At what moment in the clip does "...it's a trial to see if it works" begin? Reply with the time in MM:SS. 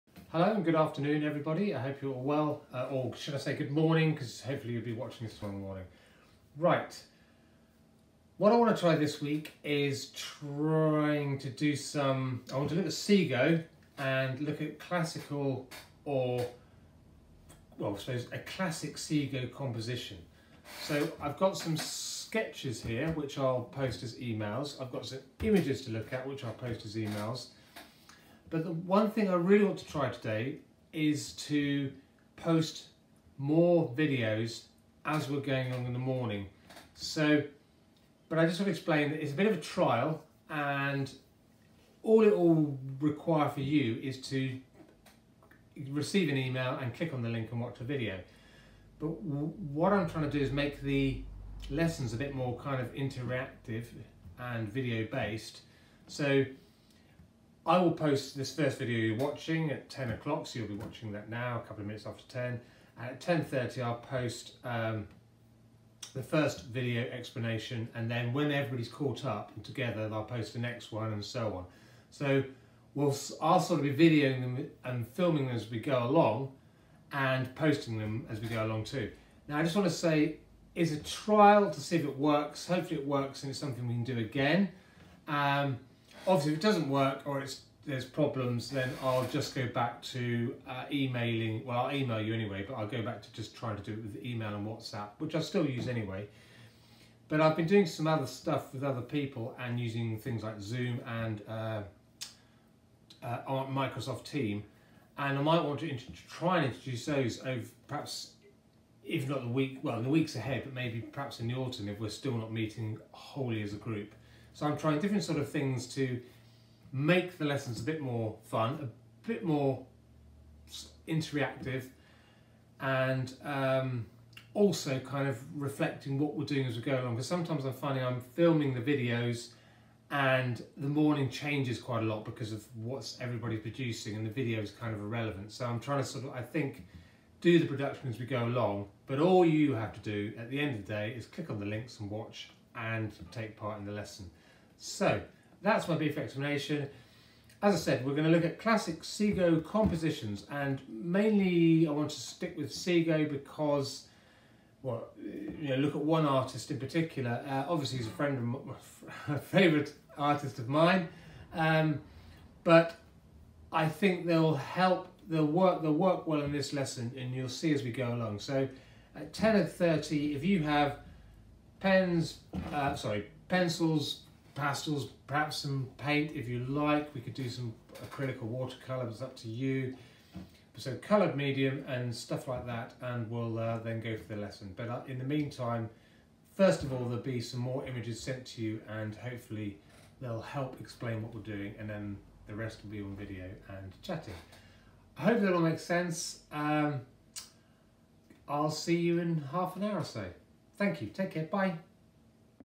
01:20.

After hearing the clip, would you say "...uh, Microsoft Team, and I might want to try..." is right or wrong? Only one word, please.
right.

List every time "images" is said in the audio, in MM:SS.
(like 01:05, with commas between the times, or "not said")
00:25, 03:07.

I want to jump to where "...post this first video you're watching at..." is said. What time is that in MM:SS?
00:57.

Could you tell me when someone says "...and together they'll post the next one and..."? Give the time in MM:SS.
01:09.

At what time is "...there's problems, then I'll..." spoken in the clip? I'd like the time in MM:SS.
01:27.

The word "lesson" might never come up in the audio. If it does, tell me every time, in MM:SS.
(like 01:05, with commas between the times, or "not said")
00:51, 01:57, 02:23, 02:46, 03:04.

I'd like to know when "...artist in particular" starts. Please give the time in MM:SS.
02:36.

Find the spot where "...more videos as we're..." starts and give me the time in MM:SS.
00:33.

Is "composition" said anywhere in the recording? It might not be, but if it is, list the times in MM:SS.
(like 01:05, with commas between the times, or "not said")
00:19, 02:29.